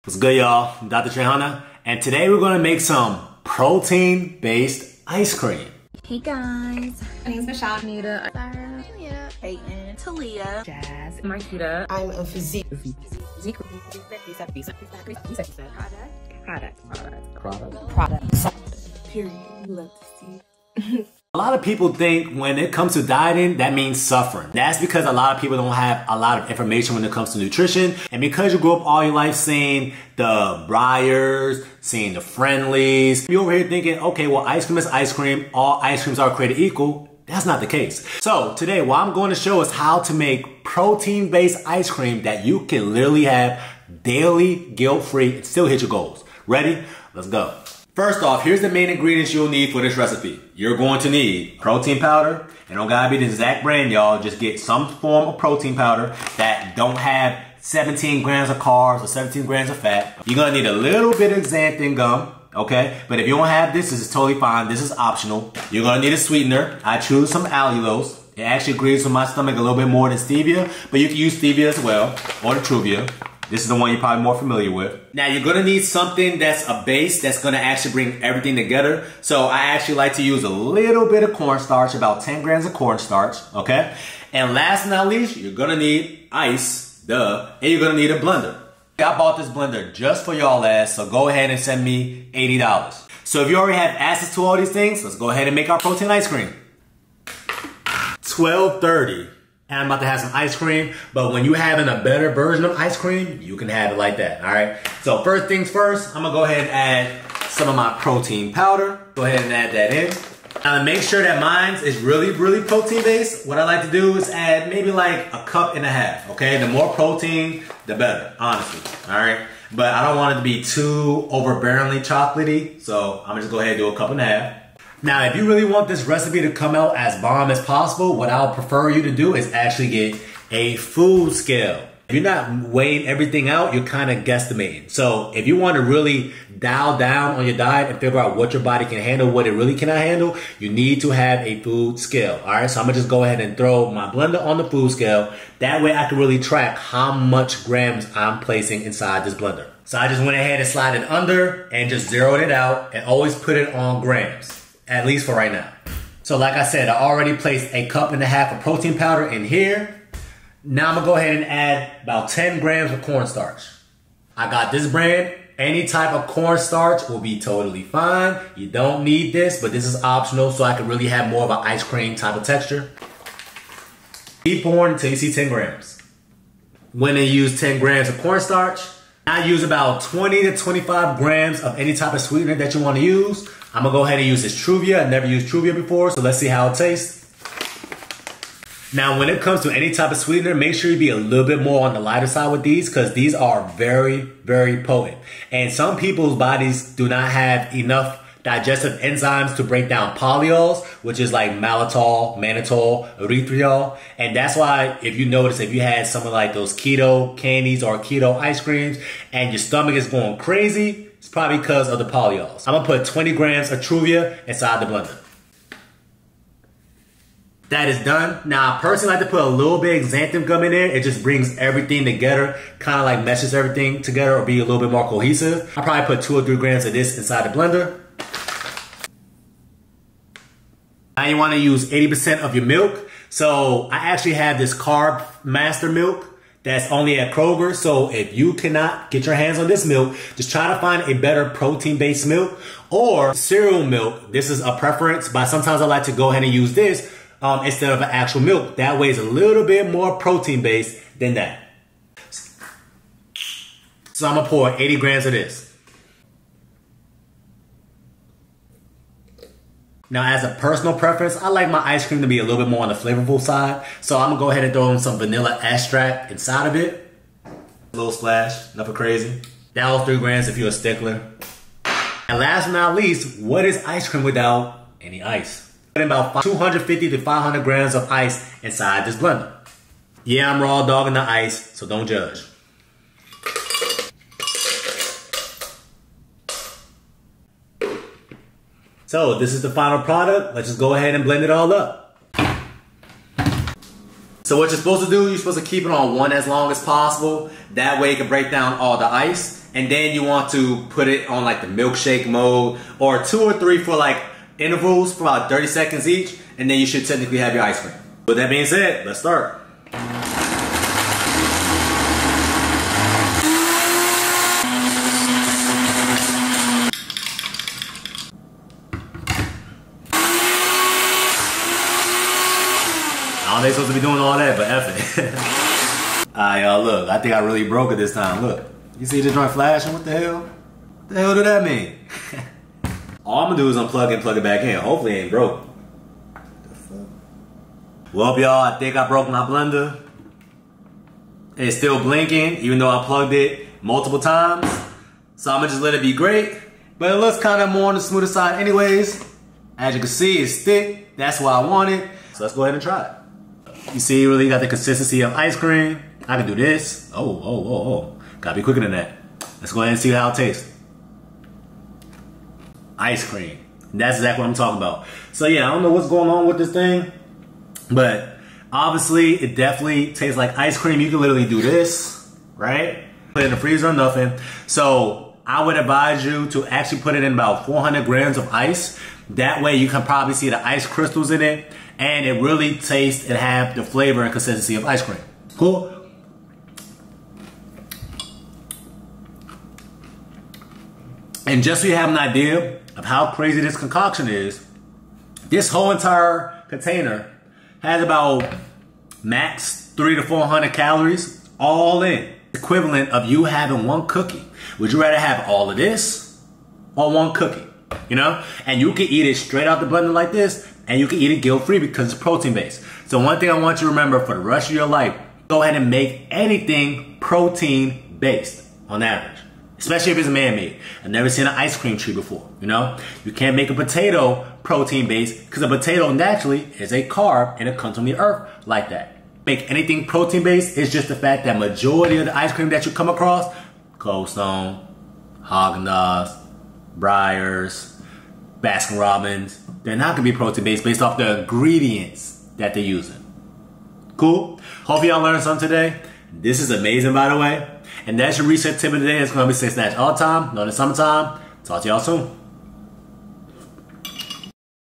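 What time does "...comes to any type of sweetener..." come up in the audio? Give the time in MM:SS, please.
03:09.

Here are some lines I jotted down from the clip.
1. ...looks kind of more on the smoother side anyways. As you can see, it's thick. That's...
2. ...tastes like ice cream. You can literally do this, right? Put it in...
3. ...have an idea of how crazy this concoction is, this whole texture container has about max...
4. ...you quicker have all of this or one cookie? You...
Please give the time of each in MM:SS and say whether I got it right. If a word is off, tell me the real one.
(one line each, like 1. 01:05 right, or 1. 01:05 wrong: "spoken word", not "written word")
1. 05:47 right
2. 06:10 right
3. 06:31 wrong: "entire", not "texture"
4. 06:44 wrong: "rather", not "quicker".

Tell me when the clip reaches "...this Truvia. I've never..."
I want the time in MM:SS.
03:04.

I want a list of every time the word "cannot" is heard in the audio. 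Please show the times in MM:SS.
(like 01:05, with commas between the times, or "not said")
02:19, 03:58.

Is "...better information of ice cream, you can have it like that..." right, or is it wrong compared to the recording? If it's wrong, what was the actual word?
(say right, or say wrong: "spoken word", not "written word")
wrong: "version", not "information".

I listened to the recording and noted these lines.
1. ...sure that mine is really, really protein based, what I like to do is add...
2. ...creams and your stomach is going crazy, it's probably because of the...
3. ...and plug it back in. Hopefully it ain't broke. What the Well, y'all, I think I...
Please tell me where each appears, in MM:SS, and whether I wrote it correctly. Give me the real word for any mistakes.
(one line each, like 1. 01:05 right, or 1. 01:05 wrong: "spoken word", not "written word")
1. 01:51 right
2. 03:28 right
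3. 05:34 right.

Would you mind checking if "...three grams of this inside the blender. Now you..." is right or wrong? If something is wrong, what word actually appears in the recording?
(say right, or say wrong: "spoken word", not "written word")
right.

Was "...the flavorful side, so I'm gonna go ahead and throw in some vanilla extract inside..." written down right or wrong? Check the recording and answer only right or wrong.
right.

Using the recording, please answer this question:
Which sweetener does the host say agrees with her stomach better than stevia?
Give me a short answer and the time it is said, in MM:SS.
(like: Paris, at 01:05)
Allulose, at 01:07.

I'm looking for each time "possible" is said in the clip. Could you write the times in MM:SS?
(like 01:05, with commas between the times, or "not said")
02:07, 04:56.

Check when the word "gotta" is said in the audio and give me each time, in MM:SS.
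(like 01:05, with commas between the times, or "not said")
00:52, 05:58.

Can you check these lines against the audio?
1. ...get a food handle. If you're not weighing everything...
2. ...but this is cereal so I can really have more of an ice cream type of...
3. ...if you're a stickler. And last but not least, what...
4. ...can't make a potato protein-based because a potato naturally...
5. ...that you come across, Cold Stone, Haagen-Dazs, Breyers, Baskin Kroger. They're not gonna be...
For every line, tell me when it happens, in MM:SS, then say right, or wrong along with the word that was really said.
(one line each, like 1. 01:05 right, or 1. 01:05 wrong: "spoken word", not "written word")
1. 02:09 wrong: "scale", not "handle"
2. 02:49 wrong: "optional", not "cereal"
3. 04:30 right
4. 07:03 right
5. 07:12 wrong: "Robbins", not "Kroger".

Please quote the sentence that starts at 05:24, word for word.
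doing all that, but F it.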